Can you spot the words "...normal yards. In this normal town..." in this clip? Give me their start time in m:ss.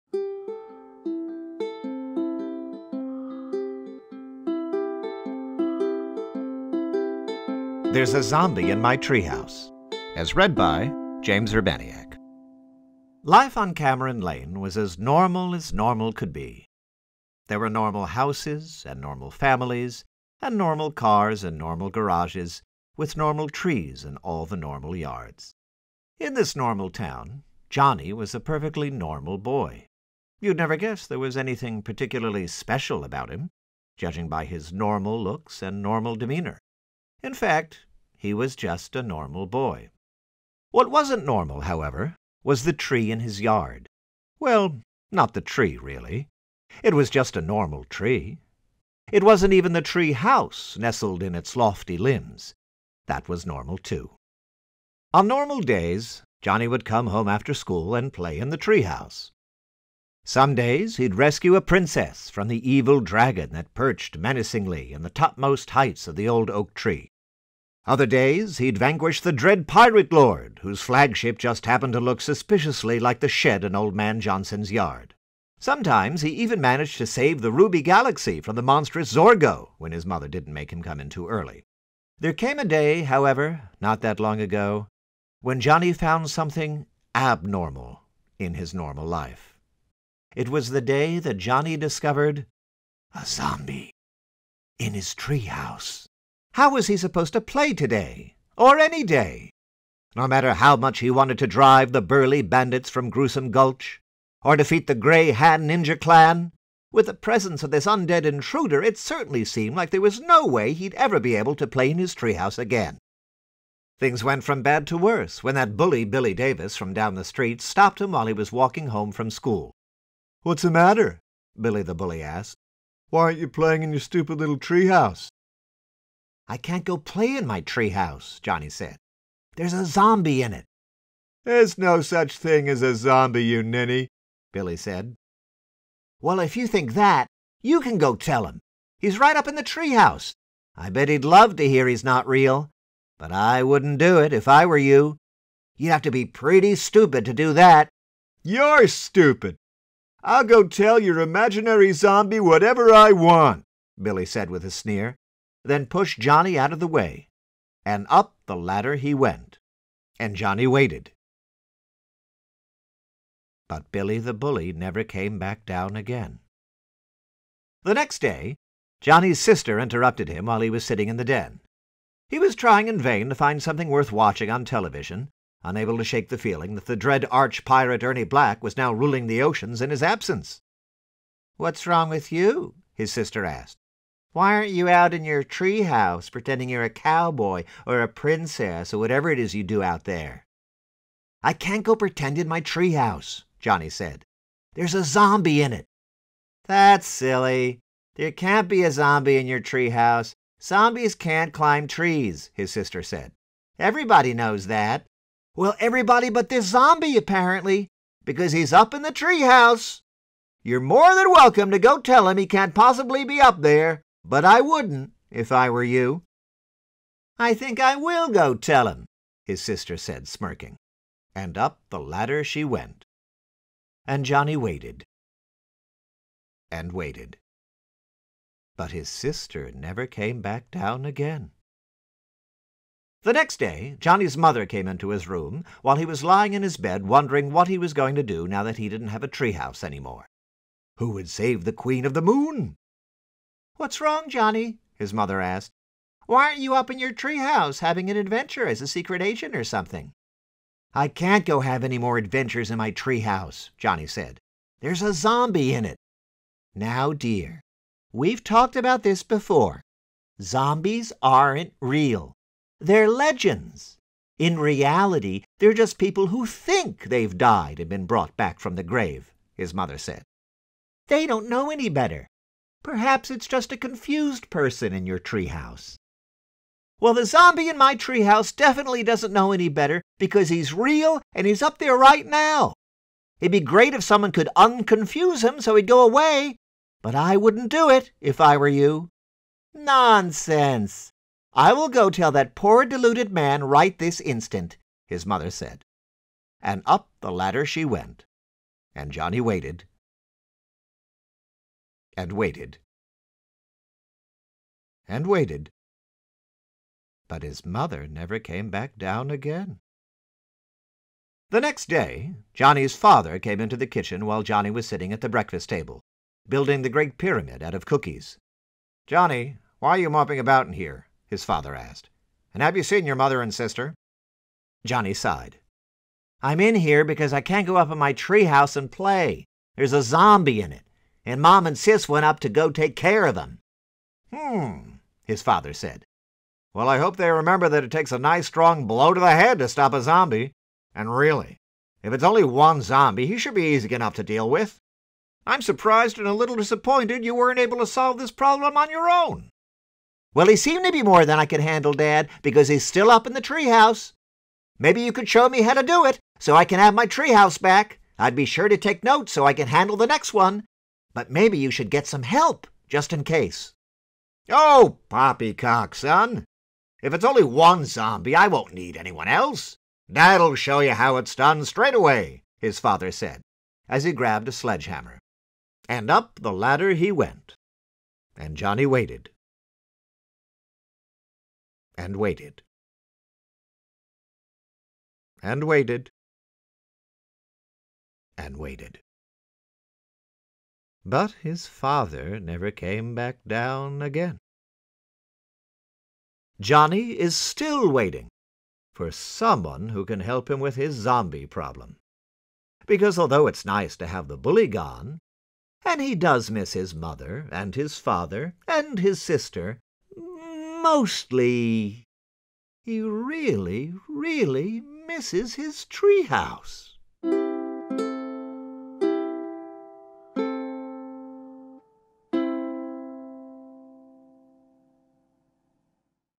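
0:24.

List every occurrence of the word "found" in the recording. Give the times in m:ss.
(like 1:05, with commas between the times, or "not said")
1:25.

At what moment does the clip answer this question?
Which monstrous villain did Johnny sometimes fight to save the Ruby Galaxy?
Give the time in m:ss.
1:19.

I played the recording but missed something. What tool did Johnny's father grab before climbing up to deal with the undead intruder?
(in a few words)
sledgehammer.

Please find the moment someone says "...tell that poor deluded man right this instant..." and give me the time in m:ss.
4:52.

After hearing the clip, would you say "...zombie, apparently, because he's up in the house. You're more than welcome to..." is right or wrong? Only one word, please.
wrong.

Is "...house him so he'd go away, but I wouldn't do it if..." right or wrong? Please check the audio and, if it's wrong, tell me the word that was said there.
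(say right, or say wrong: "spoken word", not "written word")
wrong: "unconfuse", not "house".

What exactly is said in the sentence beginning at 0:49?
It wasn't even the tree house nestled in its lofty limbs.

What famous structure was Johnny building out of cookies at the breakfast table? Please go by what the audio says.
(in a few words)
the Great Pyramid.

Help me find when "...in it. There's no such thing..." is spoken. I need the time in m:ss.
2:10.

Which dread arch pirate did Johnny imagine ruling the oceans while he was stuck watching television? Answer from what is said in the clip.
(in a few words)
Ernie Black.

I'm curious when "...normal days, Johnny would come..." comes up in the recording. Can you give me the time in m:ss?
0:55.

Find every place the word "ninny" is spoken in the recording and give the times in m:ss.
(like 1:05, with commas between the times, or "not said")
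2:13.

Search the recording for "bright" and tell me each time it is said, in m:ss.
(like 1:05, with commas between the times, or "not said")
not said.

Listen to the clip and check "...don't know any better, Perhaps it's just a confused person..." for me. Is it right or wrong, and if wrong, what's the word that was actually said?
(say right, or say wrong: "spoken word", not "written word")
right.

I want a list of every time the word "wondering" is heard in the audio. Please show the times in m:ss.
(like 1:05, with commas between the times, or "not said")
3:57.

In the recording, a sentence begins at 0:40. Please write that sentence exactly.
What wasn't normal, however, was the tree in his yard.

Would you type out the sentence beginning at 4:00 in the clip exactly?
Who would save the Queen of the Moon?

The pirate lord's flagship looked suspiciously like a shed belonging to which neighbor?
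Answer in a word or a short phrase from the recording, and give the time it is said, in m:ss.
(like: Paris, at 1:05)
old man Johnson, at 1:13.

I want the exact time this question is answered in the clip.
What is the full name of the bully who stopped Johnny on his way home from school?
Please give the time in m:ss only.
1:56.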